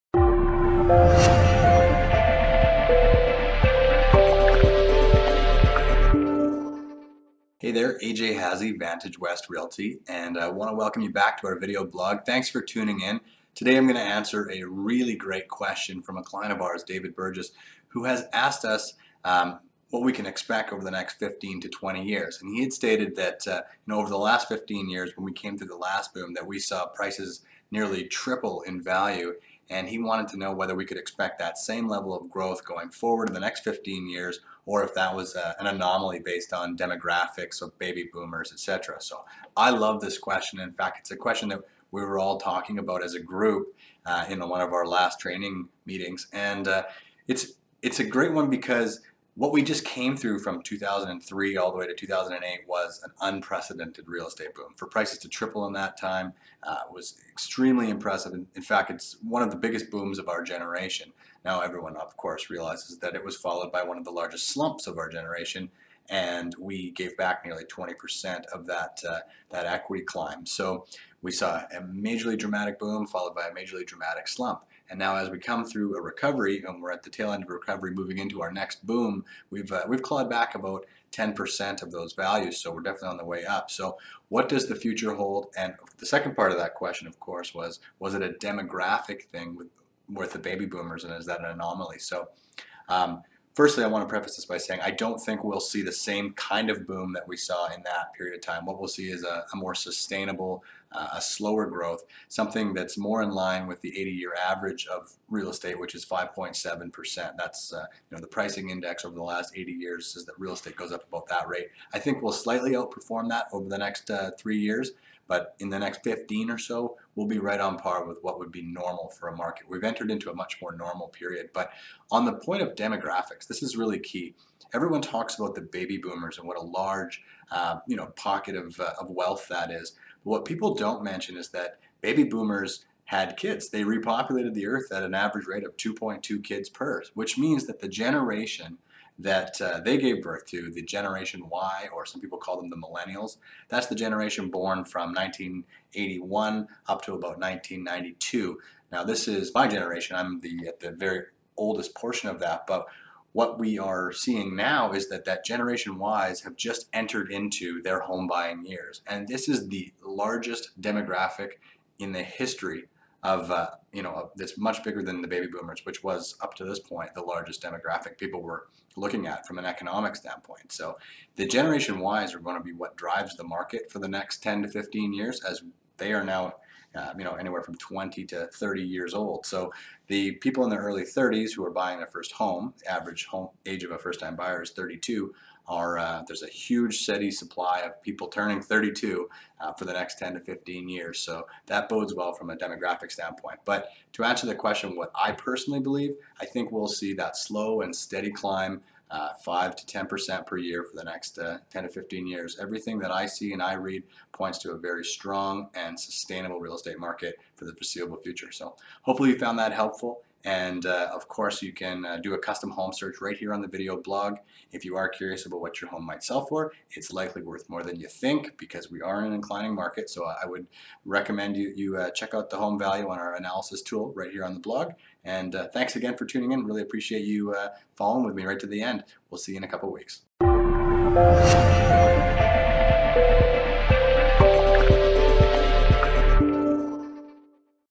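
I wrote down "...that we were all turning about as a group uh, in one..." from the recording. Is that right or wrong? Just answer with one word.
wrong.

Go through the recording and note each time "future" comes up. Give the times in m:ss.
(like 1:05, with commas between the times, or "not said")
1:24, 3:28.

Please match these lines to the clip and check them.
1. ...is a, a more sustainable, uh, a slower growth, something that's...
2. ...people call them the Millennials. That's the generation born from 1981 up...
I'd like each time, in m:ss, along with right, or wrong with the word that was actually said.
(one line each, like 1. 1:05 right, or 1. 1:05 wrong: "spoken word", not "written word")
1. 1:39 right
2. 2:22 right.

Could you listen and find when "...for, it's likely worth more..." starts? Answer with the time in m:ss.
3:36.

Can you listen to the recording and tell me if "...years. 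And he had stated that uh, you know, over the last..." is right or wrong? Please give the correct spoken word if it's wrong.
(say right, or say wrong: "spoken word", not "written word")
right.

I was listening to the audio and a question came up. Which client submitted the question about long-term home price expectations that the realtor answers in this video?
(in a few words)
David Burgess.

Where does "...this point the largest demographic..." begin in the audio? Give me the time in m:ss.
2:46.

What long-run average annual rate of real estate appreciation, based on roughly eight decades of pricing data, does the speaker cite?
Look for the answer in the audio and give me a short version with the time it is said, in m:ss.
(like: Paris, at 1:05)
5.7 percent, at 1:46.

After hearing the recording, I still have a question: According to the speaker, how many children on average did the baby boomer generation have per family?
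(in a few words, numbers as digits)
2.2.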